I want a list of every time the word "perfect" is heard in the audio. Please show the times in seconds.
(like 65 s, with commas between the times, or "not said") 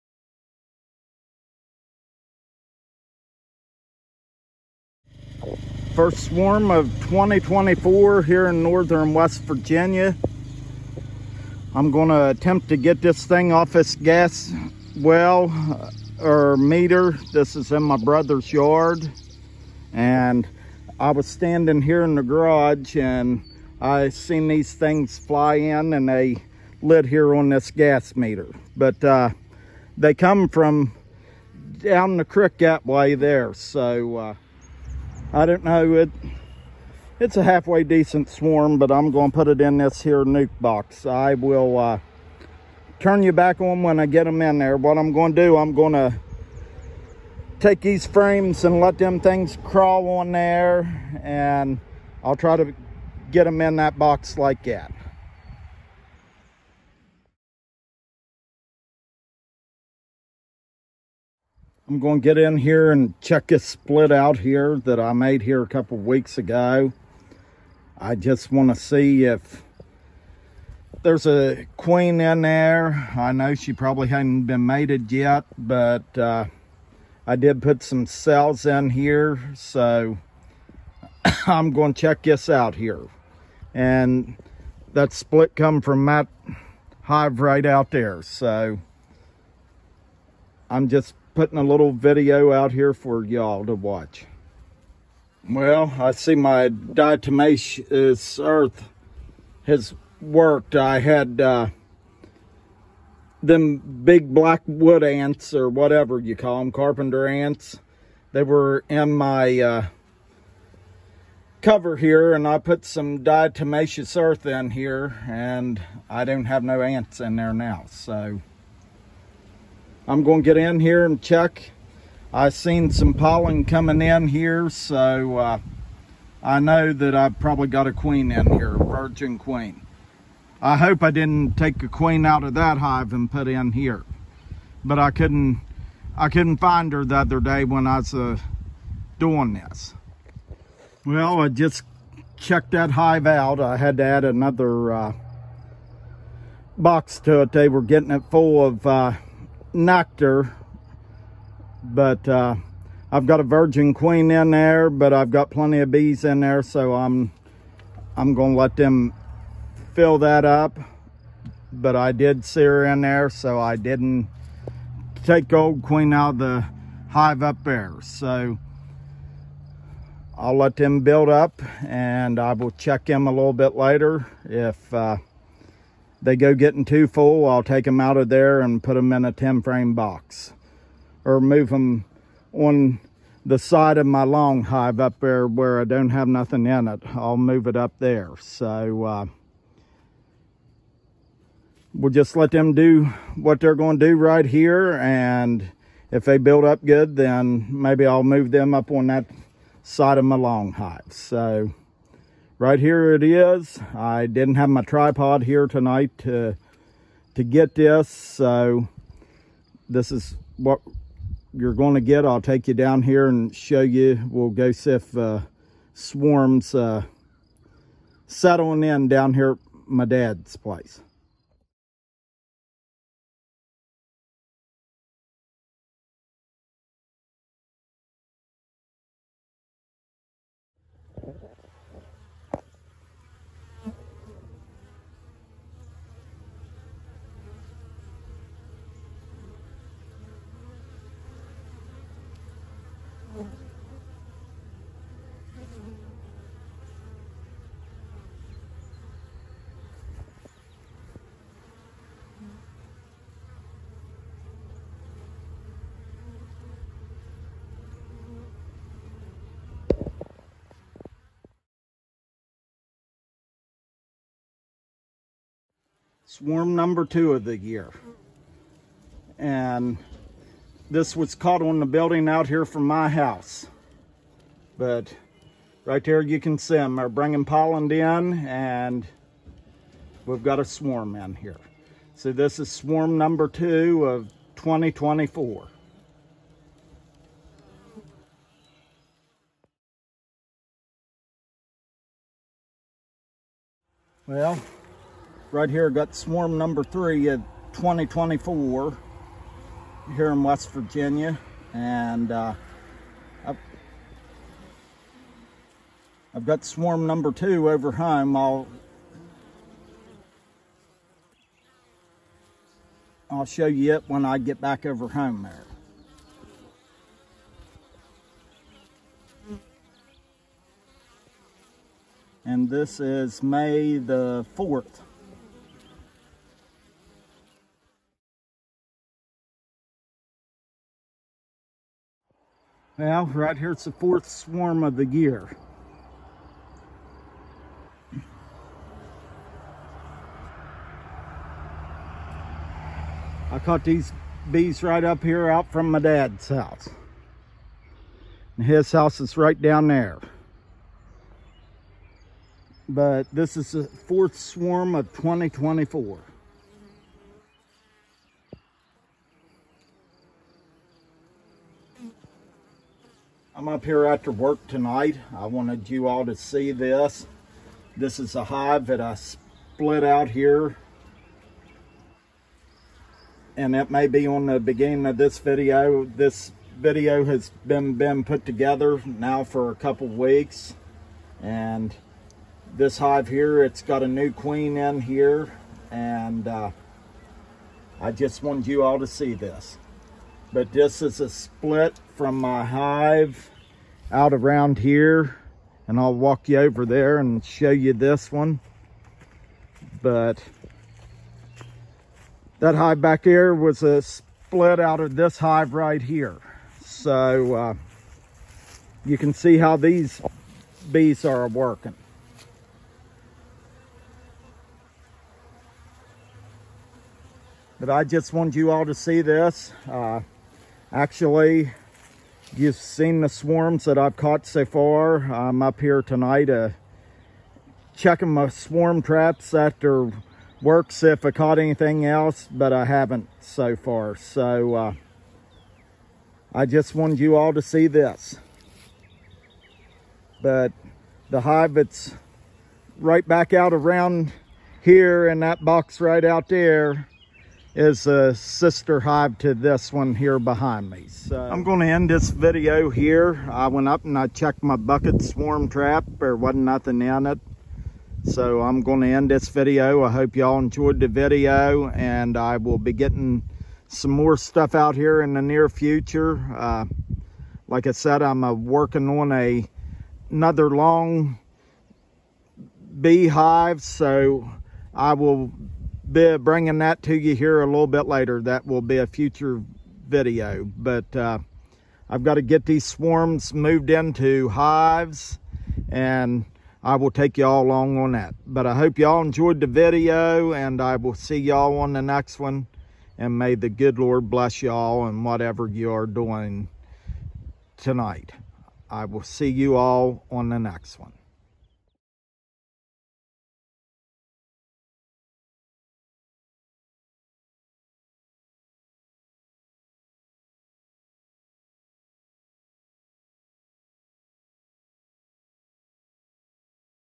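not said.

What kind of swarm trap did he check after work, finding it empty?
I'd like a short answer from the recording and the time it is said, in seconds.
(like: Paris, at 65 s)
bucket swarm trap, at 454 s.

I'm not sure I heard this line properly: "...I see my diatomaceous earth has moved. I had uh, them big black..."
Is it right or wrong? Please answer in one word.
wrong.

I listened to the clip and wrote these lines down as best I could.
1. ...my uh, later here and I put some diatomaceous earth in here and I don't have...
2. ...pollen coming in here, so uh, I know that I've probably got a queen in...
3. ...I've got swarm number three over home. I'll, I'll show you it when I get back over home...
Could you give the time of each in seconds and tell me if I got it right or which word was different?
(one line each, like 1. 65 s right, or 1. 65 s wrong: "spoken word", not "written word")
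1. 109 s wrong: "cover", not "later"
2. 123 s right
3. 306 s wrong: "two", not "three".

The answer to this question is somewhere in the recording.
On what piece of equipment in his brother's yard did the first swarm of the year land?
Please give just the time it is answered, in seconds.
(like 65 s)
27 s.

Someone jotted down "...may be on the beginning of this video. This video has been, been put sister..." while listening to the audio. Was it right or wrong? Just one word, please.
wrong.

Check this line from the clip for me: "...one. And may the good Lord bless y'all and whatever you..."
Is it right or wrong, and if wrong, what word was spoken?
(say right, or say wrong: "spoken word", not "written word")
right.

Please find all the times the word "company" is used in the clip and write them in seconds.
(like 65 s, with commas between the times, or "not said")
not said.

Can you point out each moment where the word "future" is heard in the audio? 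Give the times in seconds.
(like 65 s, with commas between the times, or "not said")
465 s, 479 s.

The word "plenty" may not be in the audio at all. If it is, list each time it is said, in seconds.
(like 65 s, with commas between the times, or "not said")
155 s.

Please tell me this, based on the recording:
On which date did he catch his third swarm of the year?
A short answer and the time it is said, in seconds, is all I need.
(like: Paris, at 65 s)
May 4, at 323 s.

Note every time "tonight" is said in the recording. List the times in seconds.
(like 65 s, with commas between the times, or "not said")
205 s, 364 s, 426 s, 497 s.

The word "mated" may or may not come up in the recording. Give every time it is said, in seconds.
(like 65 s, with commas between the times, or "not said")
74 s.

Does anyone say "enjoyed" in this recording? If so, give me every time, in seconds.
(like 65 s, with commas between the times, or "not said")
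460 s, 489 s.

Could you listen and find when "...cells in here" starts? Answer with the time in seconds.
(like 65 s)
78 s.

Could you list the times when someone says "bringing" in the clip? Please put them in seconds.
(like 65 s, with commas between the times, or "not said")
277 s, 476 s.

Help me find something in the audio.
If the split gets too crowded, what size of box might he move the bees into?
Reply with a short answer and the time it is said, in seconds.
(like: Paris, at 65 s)
10 frame, at 179 s.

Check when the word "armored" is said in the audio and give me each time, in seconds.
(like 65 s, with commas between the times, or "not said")
not said.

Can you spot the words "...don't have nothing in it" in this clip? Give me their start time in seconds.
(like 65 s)
185 s.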